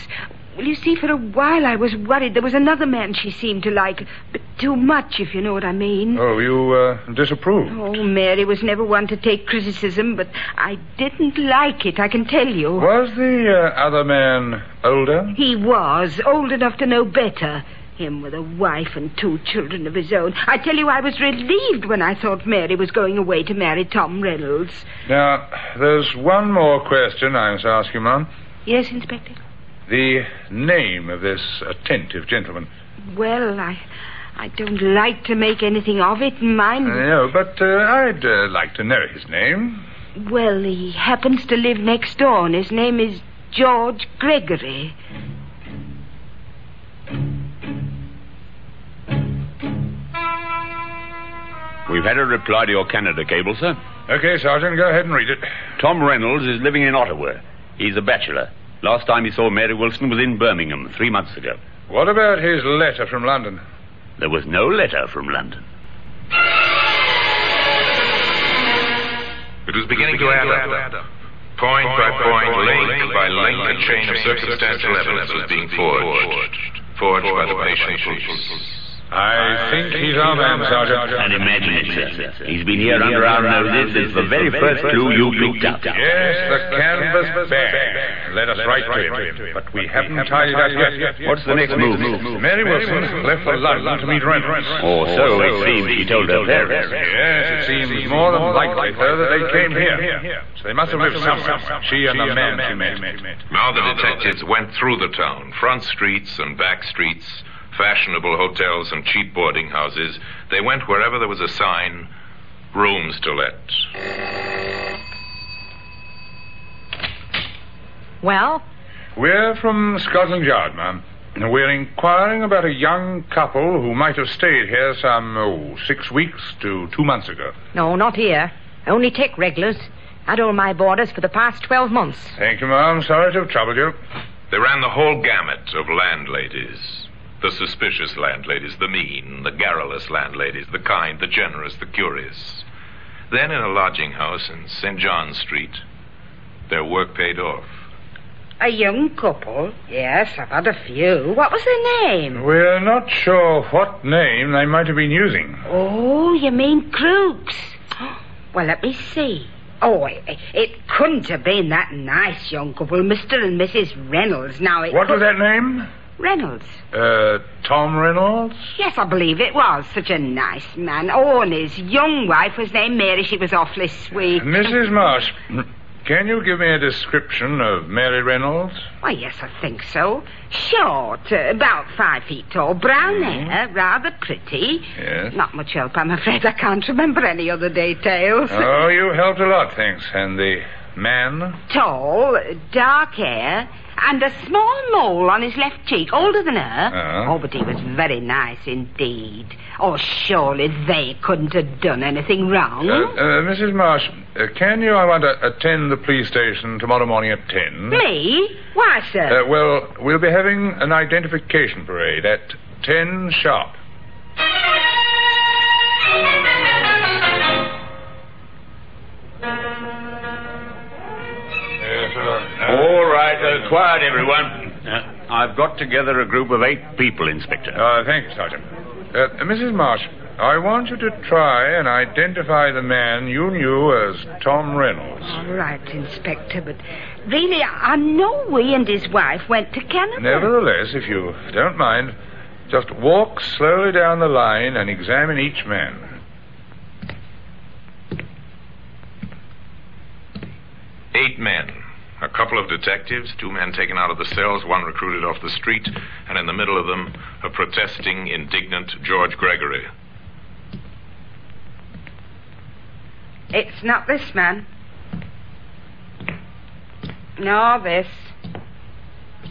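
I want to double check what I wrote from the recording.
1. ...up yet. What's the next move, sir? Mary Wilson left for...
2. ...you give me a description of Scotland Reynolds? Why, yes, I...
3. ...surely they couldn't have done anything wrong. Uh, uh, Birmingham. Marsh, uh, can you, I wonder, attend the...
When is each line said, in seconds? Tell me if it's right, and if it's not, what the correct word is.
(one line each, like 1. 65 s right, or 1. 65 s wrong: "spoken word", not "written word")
1. 90 s right
2. 176 s wrong: "Mary", not "Scotland"
3. 199 s wrong: "Mrs", not "Birmingham".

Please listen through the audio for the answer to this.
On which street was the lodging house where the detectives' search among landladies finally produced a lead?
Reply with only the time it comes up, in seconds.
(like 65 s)
144 s.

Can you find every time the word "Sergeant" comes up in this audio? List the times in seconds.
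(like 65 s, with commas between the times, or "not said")
54 s, 80 s, 228 s.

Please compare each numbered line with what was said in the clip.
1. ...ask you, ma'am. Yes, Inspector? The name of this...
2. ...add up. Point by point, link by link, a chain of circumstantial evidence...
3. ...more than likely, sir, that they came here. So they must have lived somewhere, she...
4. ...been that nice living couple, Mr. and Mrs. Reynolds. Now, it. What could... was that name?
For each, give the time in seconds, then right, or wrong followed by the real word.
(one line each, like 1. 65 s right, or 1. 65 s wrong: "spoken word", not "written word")
1. 27 s right
2. 70 s right
3. 98 s right
4. 161 s wrong: "young", not "living".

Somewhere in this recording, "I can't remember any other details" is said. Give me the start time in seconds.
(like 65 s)
186 s.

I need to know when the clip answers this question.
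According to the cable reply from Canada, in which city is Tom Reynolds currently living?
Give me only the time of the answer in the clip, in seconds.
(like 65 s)
56 s.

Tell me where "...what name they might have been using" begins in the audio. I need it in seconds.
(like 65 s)
153 s.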